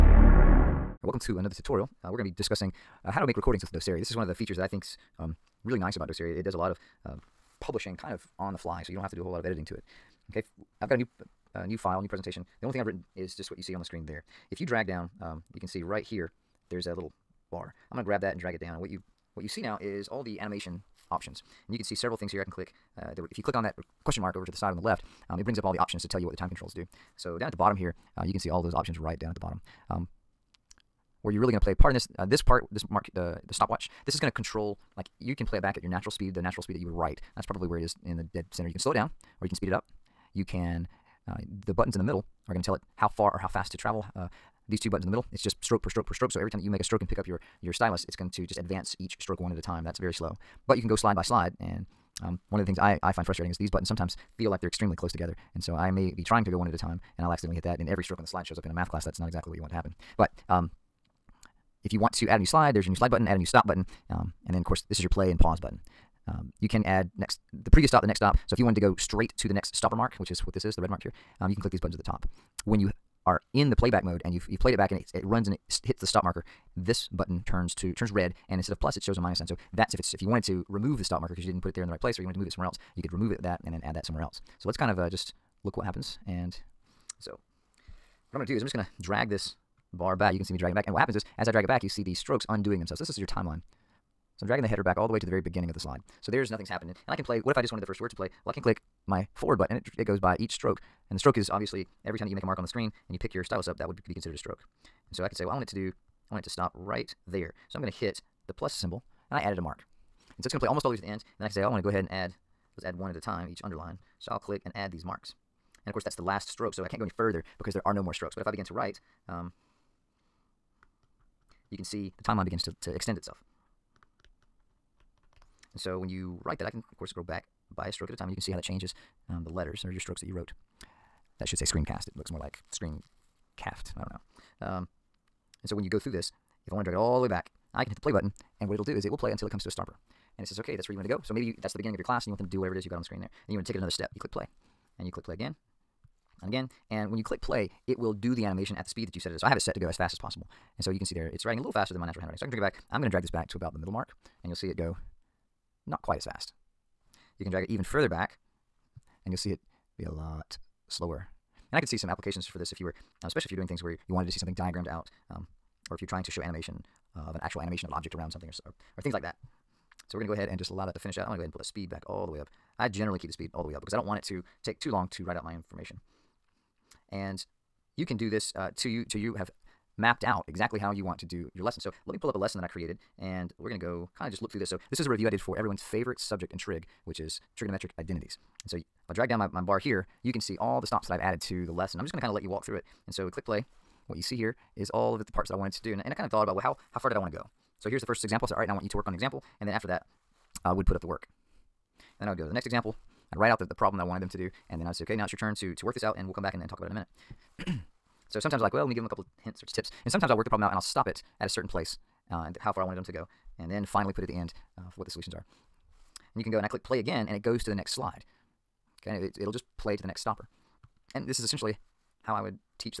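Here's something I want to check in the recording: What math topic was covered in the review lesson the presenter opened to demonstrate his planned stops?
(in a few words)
trigonometric identities.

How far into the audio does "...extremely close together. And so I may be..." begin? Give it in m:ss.
0:54.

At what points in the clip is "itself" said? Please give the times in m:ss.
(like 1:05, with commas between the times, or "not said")
2:03.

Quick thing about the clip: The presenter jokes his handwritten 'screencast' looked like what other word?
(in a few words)
screen caft.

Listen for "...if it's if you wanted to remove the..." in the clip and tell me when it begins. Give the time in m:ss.
1:19.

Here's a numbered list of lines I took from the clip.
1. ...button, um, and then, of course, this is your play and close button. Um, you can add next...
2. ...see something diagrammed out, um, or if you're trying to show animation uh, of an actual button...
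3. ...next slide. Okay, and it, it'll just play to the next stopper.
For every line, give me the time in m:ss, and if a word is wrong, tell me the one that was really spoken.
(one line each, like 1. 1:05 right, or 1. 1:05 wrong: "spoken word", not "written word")
1. 1:03 wrong: "pause", not "close"
2. 2:44 wrong: "animation", not "button"
3. 3:37 right.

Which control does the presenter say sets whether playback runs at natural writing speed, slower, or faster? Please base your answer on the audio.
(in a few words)
the stopwatch.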